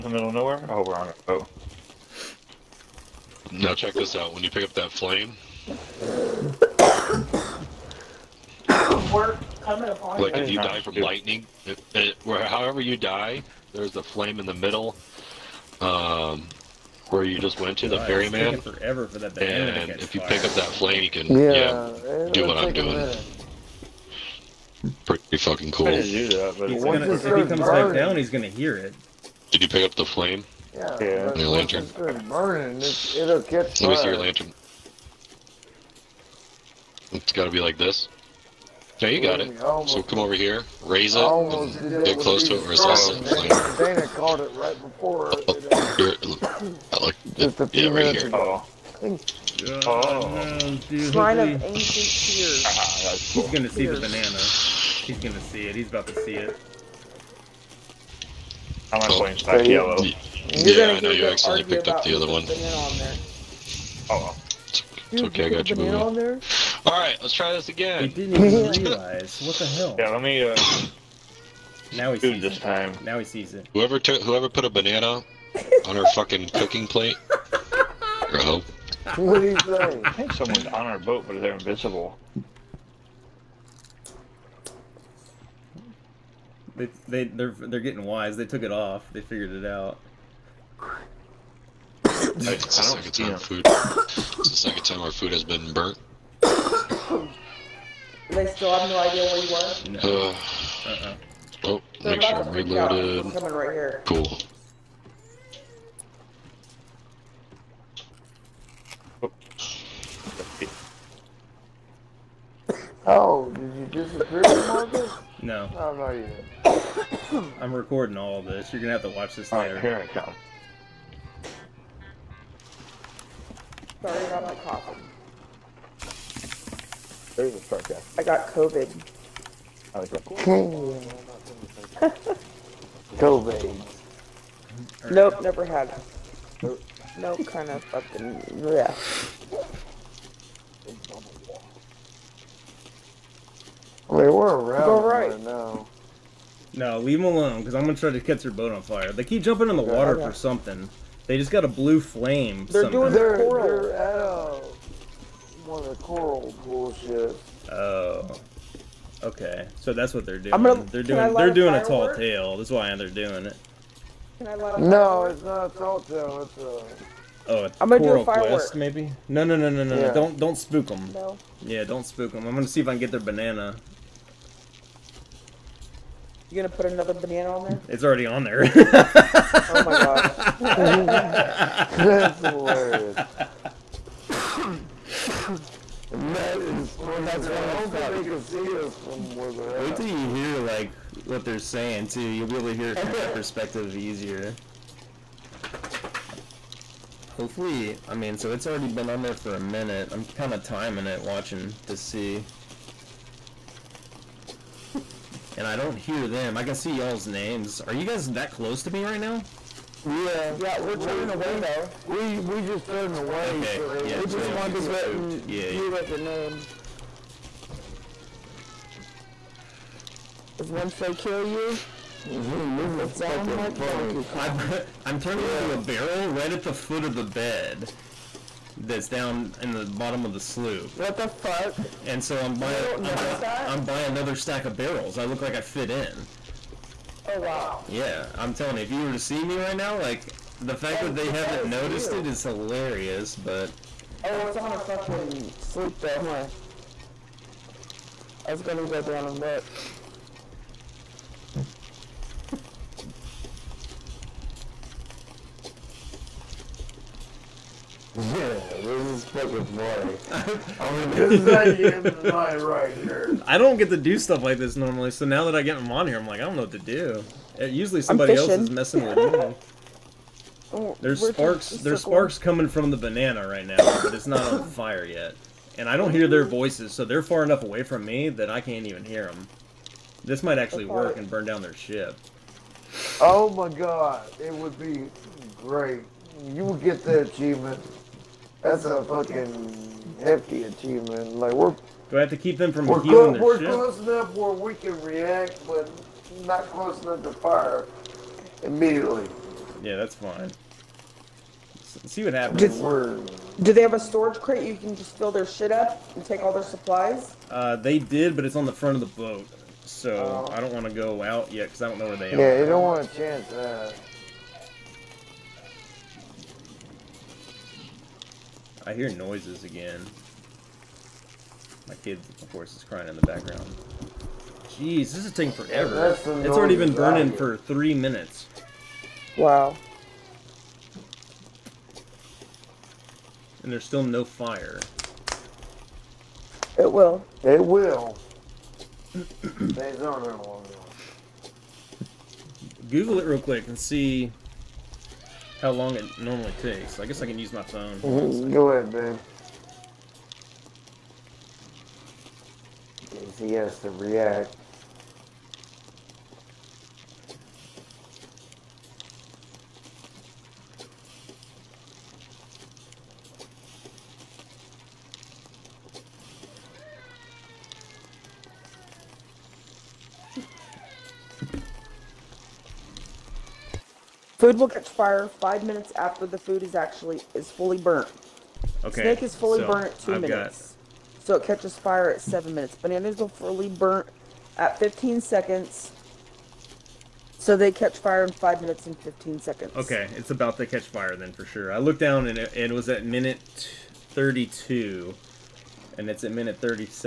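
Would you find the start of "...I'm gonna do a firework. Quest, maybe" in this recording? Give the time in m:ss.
2:47.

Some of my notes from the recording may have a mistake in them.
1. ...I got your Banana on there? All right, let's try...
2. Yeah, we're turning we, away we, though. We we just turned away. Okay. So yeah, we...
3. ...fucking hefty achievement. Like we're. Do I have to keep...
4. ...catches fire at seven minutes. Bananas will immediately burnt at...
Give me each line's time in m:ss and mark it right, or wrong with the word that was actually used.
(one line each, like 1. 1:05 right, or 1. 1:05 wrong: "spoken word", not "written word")
1. 1:05 right
2. 3:30 right
3. 4:49 right
4. 6:21 wrong: "fully", not "immediately".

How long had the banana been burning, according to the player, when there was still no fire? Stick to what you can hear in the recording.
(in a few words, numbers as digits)
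3 minutes.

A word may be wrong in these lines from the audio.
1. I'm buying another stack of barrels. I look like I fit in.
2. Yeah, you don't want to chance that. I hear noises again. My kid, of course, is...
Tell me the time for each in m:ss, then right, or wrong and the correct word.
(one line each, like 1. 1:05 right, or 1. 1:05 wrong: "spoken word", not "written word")
1. 3:53 right
2. 5:12 right.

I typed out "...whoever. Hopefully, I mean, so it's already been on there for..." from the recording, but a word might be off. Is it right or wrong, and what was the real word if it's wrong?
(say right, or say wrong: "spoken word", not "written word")
wrong: "easier", not "whoever".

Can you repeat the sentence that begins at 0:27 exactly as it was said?
back down, he's gonna hear it.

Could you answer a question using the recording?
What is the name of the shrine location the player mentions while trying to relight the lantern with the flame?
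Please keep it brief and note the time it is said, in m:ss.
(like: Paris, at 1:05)
Shrine of ancient tears, at 0:51.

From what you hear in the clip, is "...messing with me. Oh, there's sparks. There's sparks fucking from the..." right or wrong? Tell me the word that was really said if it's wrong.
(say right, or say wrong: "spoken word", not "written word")
wrong: "coming", not "fucking".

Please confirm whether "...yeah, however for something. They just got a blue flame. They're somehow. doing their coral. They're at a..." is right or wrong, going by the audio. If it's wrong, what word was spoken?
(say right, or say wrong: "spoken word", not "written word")
wrong: "water", not "however".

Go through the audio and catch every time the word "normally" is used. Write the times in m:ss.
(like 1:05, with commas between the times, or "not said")
4:24, 5:46.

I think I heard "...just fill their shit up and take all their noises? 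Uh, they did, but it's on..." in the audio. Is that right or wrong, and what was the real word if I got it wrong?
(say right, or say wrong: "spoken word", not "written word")
wrong: "supplies", not "noises".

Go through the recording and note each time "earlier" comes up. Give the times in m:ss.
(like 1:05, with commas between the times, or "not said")
not said.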